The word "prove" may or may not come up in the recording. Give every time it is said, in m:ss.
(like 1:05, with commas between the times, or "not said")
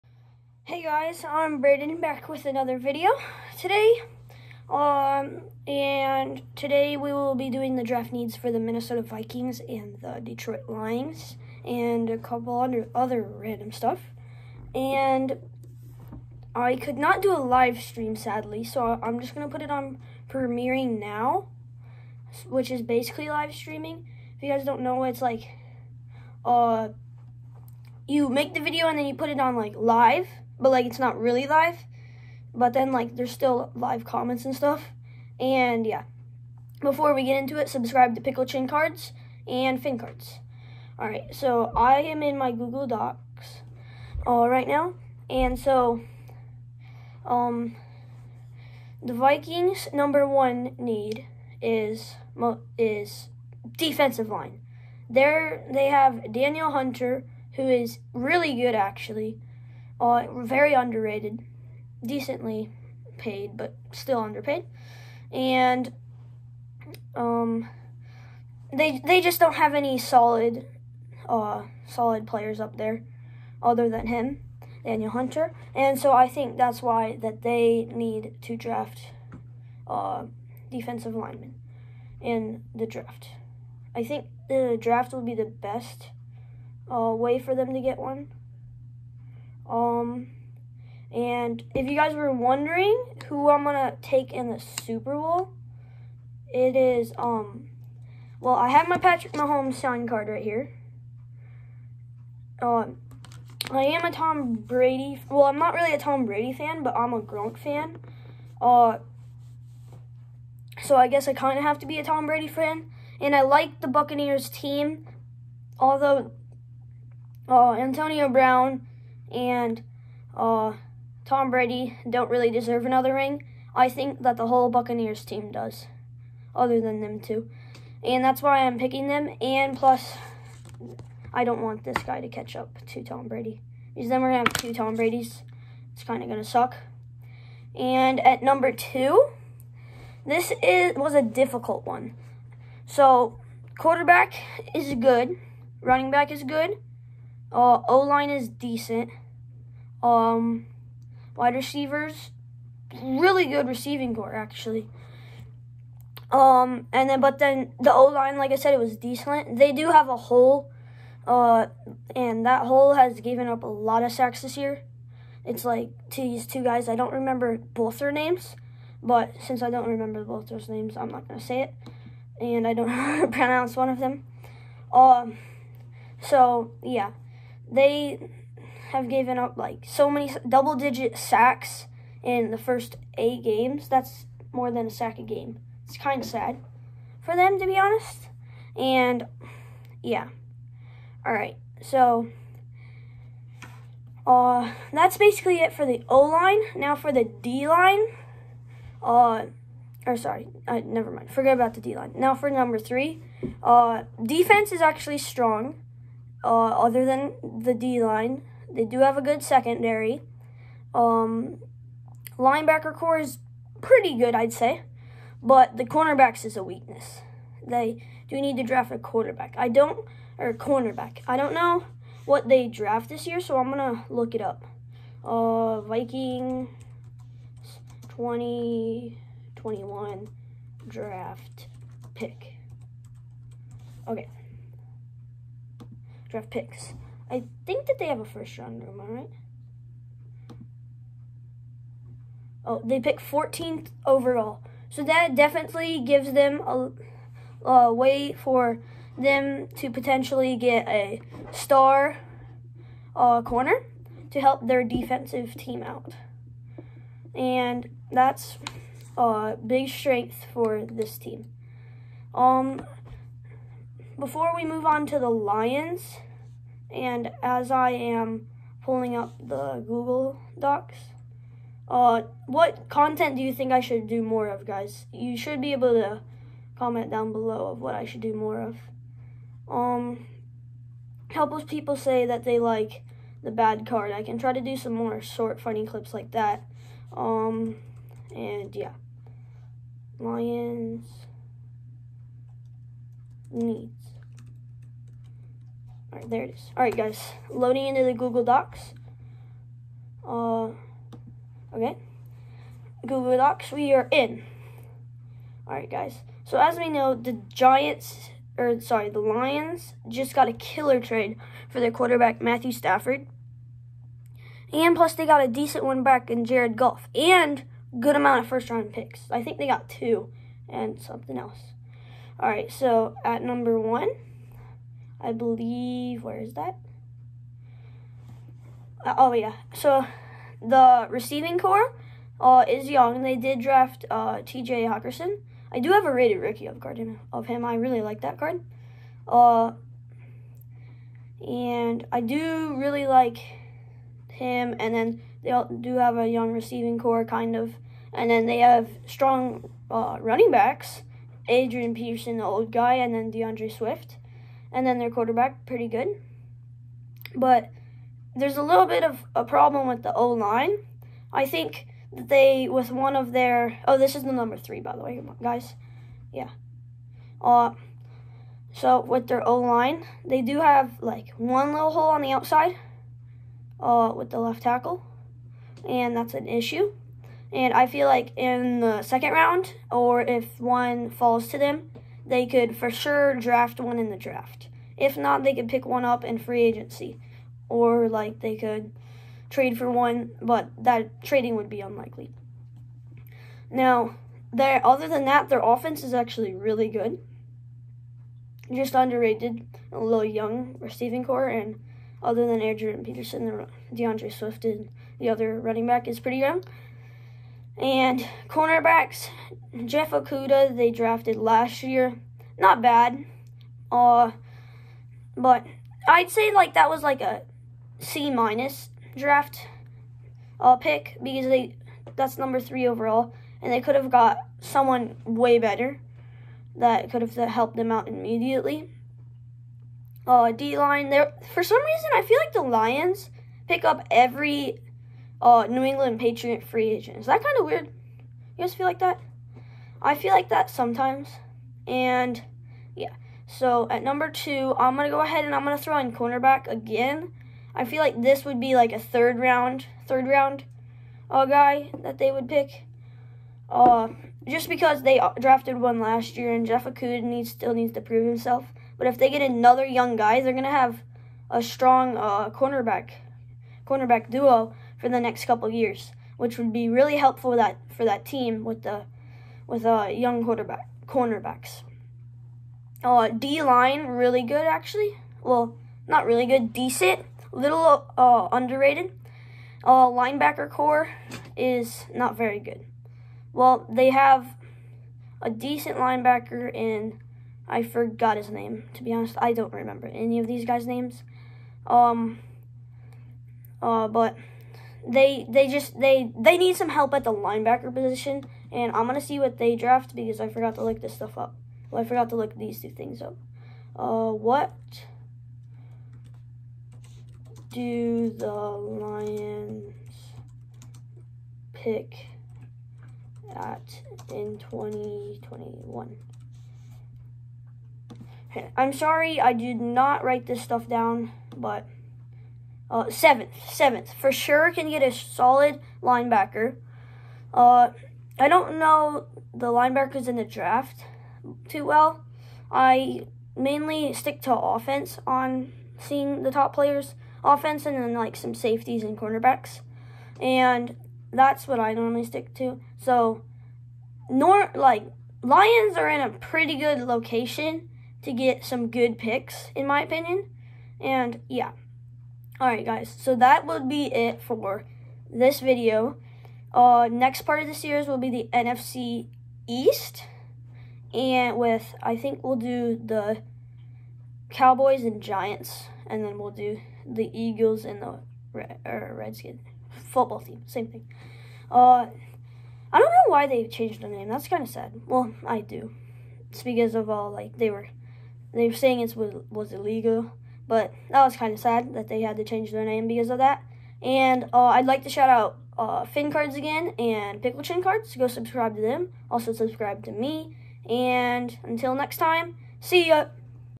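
7:38.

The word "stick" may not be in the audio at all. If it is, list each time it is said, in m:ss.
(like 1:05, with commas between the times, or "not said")
8:54, 9:02.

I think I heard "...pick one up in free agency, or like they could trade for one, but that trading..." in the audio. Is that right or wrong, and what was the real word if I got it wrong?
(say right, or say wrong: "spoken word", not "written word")
right.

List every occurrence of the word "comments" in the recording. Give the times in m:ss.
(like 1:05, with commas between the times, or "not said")
0:34, 4:36.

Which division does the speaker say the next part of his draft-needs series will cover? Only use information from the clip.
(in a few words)
NFC East.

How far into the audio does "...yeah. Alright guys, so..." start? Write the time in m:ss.
9:11.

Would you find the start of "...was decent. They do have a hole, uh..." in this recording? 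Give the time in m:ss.
2:38.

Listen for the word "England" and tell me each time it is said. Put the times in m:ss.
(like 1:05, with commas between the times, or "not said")
7:15.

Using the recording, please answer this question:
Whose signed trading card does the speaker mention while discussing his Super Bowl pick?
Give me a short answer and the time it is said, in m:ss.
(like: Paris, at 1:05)
Patrick Mahomes, at 1:38.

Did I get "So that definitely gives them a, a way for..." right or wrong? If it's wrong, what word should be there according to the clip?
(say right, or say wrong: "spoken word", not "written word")
right.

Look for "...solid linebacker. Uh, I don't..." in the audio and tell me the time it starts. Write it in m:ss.
8:45.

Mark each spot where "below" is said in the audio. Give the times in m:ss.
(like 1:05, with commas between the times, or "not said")
4:37.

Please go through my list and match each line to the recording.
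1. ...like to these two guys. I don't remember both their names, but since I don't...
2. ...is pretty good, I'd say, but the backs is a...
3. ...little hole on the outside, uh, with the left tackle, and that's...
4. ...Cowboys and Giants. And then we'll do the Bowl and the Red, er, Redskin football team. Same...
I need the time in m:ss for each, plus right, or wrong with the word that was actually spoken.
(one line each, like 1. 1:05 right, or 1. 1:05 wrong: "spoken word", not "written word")
1. 2:45 right
2. 3:33 wrong: "cornerbacks", not "backs"
3. 6:11 right
4. 9:24 wrong: "Eagles", not "Bowl".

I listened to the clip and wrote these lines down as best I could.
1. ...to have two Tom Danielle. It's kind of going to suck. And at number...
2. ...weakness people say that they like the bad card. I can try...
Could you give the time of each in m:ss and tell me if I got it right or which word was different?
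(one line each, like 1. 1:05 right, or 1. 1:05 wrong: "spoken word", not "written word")
1. 2:14 wrong: "Bradys", not "Danielle"
2. 4:41 wrong: "helpless", not "weakness".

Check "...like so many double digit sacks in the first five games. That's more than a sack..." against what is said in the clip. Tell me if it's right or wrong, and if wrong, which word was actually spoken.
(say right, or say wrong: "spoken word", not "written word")
wrong: "eight", not "five".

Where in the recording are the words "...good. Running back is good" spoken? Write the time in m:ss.
2:24.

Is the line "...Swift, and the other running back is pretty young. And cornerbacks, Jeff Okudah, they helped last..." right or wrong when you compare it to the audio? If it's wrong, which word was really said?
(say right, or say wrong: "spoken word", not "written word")
wrong: "drafted", not "helped".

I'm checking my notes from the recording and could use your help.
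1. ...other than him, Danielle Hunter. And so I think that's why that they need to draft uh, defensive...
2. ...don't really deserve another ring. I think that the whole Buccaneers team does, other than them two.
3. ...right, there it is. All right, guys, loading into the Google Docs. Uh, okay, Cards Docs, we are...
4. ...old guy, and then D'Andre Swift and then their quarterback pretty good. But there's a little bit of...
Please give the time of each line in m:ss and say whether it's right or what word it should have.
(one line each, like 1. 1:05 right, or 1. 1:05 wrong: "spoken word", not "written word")
1. 1:13 right
2. 2:02 right
3. 4:56 wrong: "Google", not "Cards"
4. 5:52 right.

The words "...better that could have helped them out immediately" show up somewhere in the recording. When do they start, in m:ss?
7:05.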